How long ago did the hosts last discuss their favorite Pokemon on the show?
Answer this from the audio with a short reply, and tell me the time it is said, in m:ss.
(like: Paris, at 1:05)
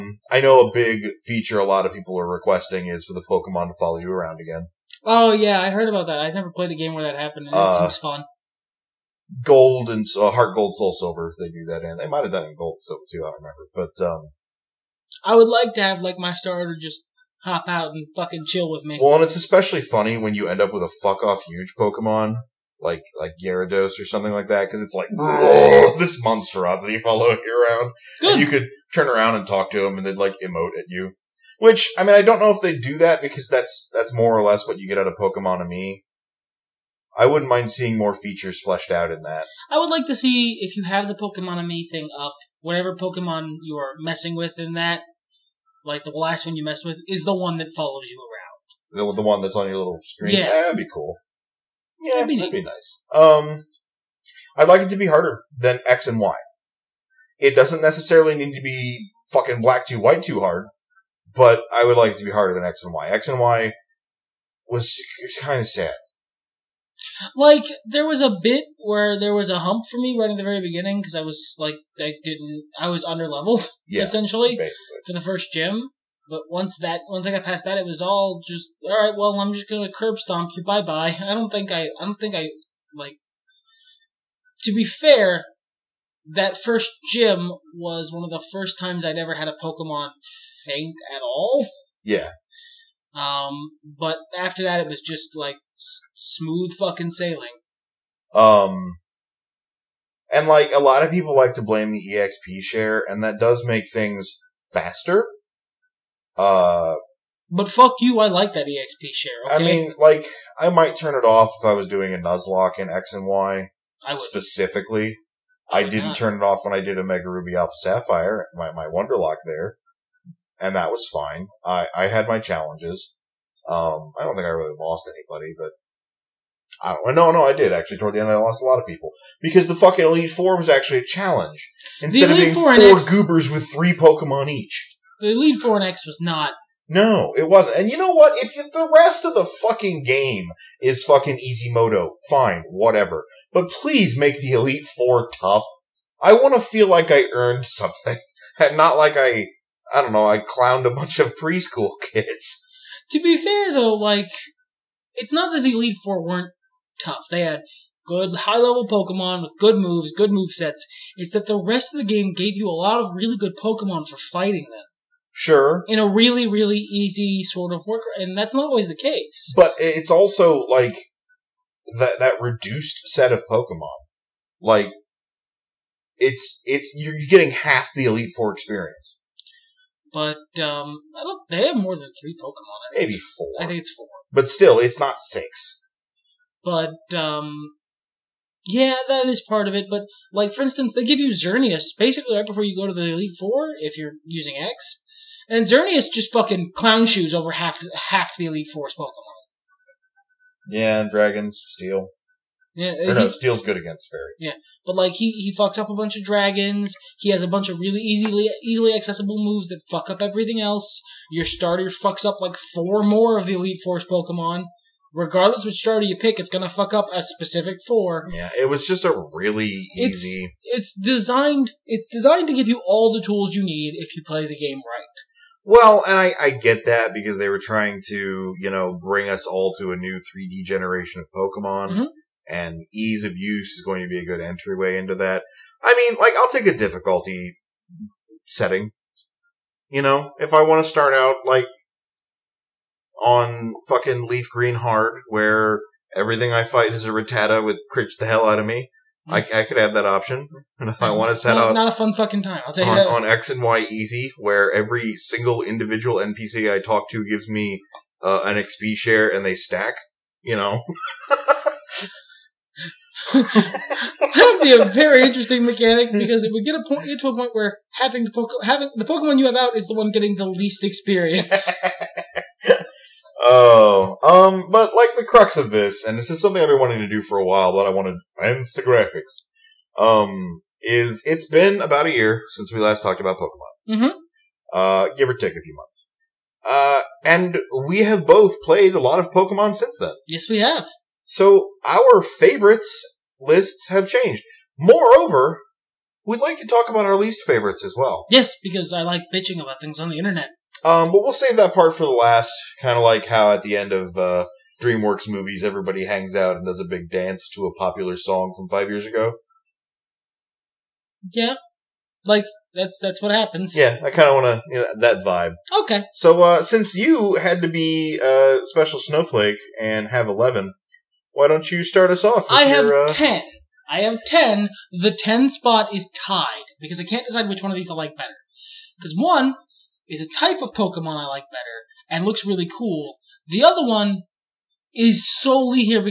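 about a year, at 4:41.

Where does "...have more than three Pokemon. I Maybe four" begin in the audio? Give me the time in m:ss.
3:01.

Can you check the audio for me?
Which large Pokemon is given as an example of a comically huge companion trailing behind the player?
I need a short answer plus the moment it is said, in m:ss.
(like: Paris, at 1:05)
Gyarados, at 0:23.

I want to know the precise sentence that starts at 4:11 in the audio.
Not a fun fucking time, I'll on, that.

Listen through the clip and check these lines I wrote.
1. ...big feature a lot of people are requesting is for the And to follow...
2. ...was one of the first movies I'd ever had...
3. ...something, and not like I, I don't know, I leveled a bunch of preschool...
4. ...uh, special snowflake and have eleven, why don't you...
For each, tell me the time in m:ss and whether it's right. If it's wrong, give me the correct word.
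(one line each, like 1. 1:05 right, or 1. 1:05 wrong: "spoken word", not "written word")
1. 0:00 wrong: "Pokemon", not "And"
2. 1:27 wrong: "times", not "movies"
3. 2:27 wrong: "clowned", not "leveled"
4. 5:18 right.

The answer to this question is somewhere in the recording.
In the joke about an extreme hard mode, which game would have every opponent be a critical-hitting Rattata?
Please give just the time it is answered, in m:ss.
4:04.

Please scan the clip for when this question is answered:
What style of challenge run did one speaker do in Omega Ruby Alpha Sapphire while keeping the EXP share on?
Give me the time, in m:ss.
1:58.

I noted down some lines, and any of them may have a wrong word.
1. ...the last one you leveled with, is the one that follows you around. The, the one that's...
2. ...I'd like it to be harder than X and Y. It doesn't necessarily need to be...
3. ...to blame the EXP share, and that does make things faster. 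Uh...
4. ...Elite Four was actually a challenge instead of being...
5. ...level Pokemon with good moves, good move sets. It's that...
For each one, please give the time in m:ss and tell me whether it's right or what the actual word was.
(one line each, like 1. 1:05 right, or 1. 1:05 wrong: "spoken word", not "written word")
1. 0:46 wrong: "messed", not "leveled"
2. 0:54 right
3. 1:41 right
4. 2:10 right
5. 2:38 right.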